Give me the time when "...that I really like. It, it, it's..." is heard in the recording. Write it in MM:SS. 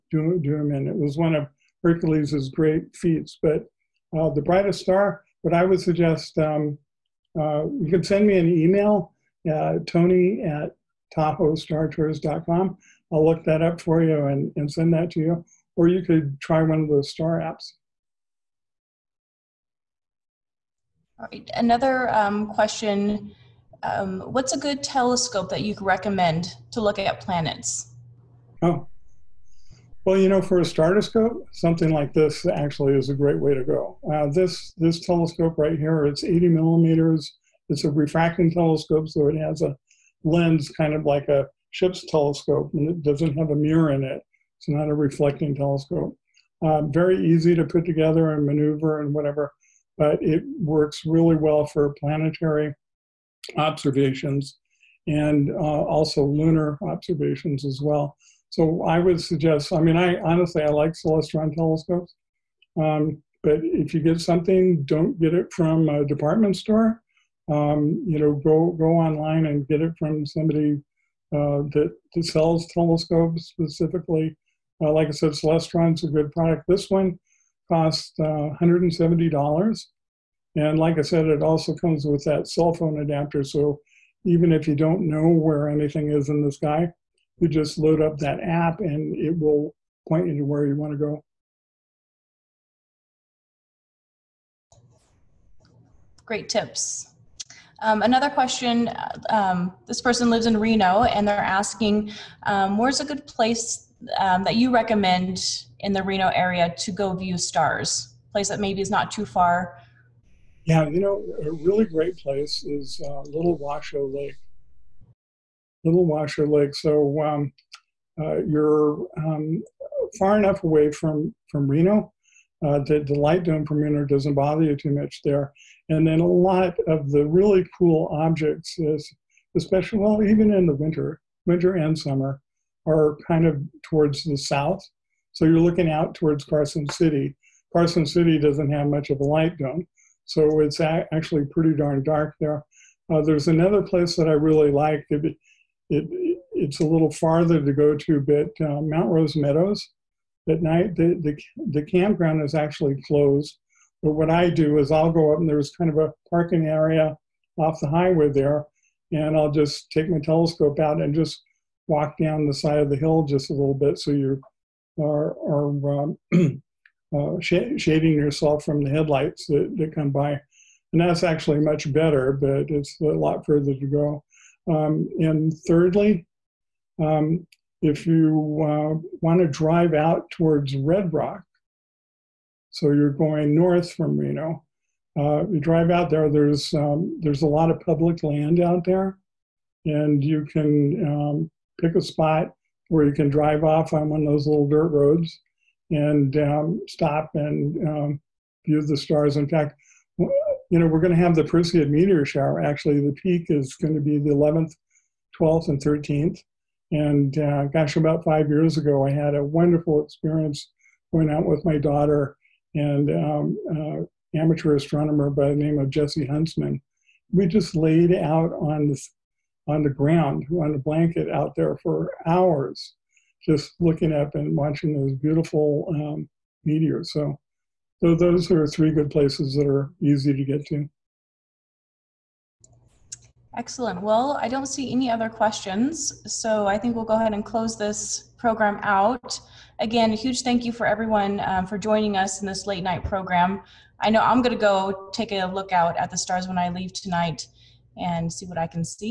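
02:24.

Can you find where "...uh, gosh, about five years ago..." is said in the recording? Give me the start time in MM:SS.
03:27.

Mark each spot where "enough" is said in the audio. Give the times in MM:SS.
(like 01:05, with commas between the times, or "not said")
02:00.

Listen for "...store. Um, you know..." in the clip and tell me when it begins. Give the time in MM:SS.
01:06.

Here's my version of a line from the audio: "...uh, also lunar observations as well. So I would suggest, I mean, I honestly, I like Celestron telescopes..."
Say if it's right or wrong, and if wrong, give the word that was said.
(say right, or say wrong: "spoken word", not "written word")
right.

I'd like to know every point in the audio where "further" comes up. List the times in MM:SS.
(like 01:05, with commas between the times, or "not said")
02:53.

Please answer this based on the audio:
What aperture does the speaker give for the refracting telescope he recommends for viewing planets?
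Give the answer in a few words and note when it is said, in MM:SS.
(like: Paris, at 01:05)
80 millimeters, at 00:36.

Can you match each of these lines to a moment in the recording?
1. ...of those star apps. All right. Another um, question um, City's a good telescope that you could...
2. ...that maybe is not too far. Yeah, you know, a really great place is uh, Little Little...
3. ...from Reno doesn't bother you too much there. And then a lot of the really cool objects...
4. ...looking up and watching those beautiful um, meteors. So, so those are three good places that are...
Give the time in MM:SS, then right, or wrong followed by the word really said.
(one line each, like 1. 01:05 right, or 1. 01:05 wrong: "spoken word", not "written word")
1. 00:16 wrong: "What", not "City"
2. 01:48 wrong: "Washoe", not "Little"
3. 02:03 right
4. 03:43 right.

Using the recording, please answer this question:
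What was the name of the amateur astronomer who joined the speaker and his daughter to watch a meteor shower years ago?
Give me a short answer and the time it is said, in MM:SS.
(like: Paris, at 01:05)
Jesse Huntsman, at 03:35.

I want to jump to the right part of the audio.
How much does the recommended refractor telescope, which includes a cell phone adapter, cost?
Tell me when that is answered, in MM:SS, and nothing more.
01:18.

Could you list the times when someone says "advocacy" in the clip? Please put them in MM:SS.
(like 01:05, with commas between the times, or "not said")
not said.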